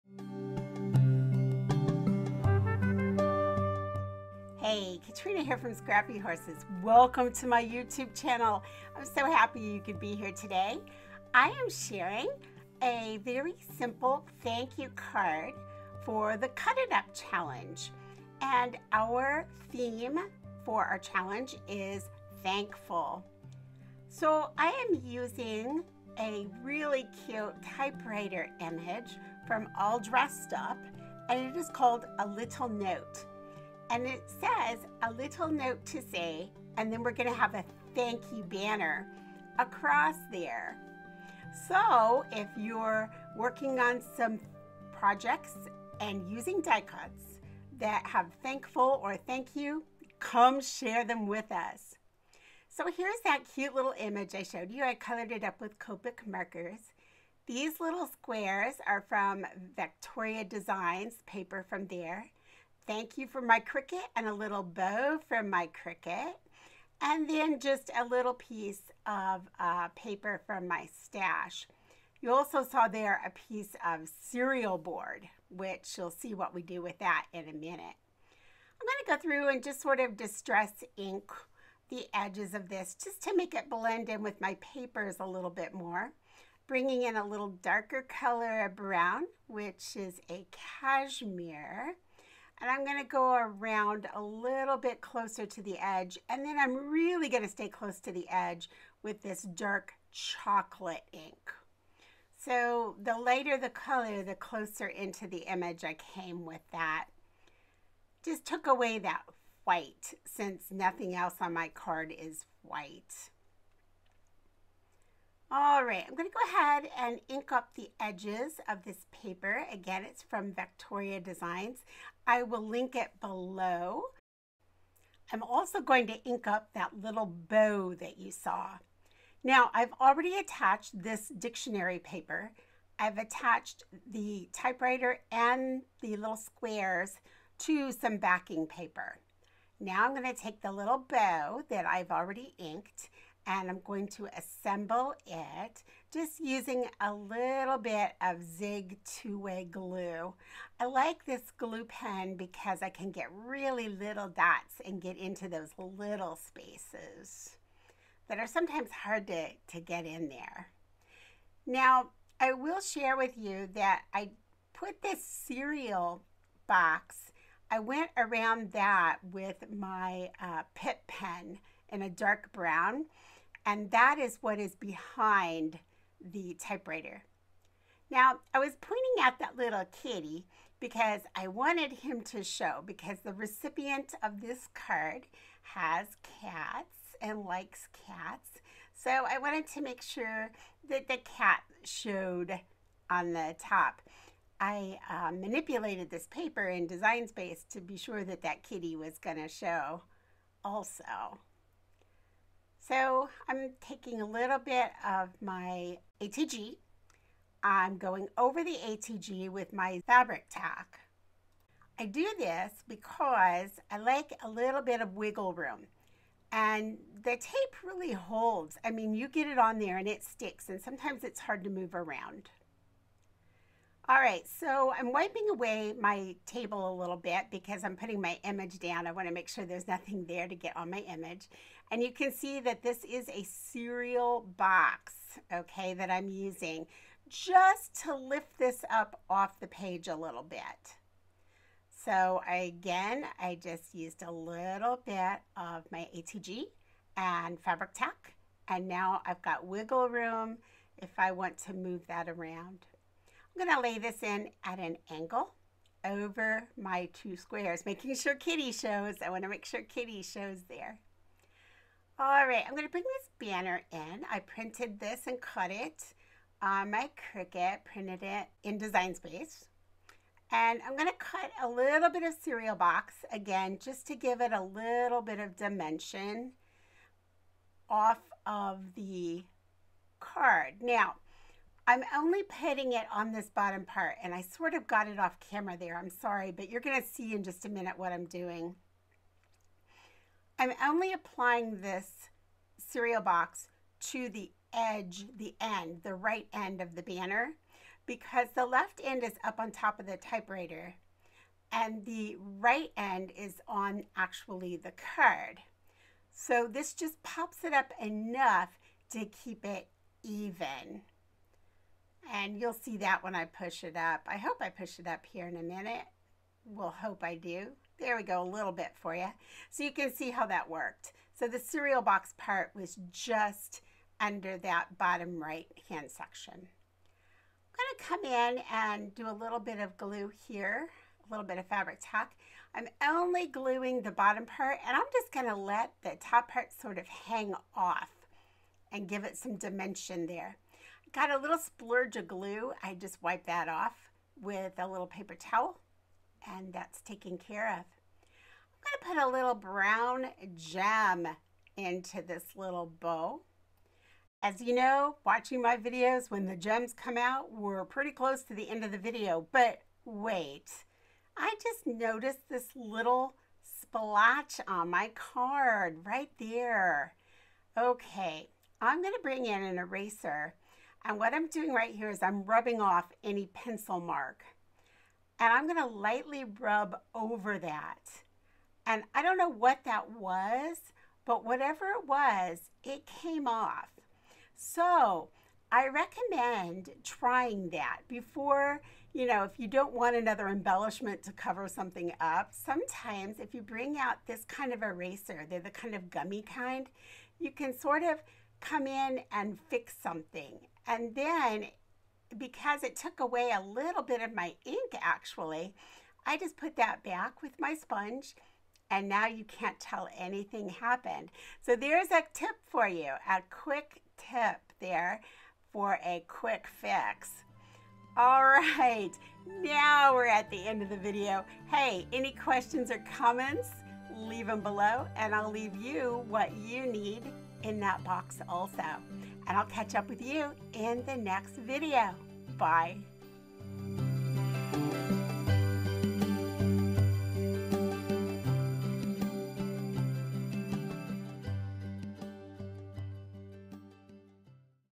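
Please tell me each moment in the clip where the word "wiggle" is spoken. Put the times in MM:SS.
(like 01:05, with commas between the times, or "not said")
03:35, 04:09.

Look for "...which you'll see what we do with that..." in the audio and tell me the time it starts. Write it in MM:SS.
01:15.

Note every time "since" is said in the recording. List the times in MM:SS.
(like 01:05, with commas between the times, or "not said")
01:50.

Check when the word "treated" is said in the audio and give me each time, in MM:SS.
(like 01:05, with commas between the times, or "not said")
not said.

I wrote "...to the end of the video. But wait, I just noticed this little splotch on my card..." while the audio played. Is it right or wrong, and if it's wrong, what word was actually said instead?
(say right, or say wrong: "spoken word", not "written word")
right.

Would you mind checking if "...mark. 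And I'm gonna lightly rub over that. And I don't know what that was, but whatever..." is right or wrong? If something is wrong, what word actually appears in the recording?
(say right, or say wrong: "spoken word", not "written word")
right.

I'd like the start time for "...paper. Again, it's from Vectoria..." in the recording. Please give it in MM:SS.
01:59.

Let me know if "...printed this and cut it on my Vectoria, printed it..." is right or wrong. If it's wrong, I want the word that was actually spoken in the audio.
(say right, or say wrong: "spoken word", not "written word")
wrong: "Cricut", not "Vectoria".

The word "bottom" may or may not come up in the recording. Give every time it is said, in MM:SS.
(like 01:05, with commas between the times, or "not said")
04:43, 05:24, 05:34.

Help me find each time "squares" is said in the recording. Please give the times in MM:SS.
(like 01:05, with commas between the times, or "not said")
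00:58, 02:16, 04:17.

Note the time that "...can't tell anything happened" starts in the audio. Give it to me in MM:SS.
06:49.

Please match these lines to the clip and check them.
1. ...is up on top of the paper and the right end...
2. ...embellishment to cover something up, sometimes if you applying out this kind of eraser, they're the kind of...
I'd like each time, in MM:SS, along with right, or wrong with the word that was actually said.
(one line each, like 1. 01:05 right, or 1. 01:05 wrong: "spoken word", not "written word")
1. 04:59 wrong: "typewriter", not "paper"
2. 06:30 wrong: "bring", not "applying".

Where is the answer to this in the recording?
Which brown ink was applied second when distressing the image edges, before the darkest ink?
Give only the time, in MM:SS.
01:30.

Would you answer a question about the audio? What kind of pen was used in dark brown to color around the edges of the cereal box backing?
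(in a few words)
Pitt pen.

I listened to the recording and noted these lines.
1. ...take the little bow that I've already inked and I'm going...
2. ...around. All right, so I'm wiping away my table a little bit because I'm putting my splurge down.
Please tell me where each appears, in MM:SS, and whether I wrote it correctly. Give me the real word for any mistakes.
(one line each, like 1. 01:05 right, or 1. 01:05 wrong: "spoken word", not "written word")
1. 02:20 right
2. 03:41 wrong: "image", not "splurge".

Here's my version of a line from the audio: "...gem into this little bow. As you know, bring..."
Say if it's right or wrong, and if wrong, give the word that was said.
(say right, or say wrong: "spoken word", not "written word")
wrong: "watching", not "bring".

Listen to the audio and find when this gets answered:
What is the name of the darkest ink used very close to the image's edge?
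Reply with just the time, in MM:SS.
01:39.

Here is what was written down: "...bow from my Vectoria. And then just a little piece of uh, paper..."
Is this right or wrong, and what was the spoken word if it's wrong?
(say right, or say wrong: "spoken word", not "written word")
wrong: "Cricut", not "Vectoria".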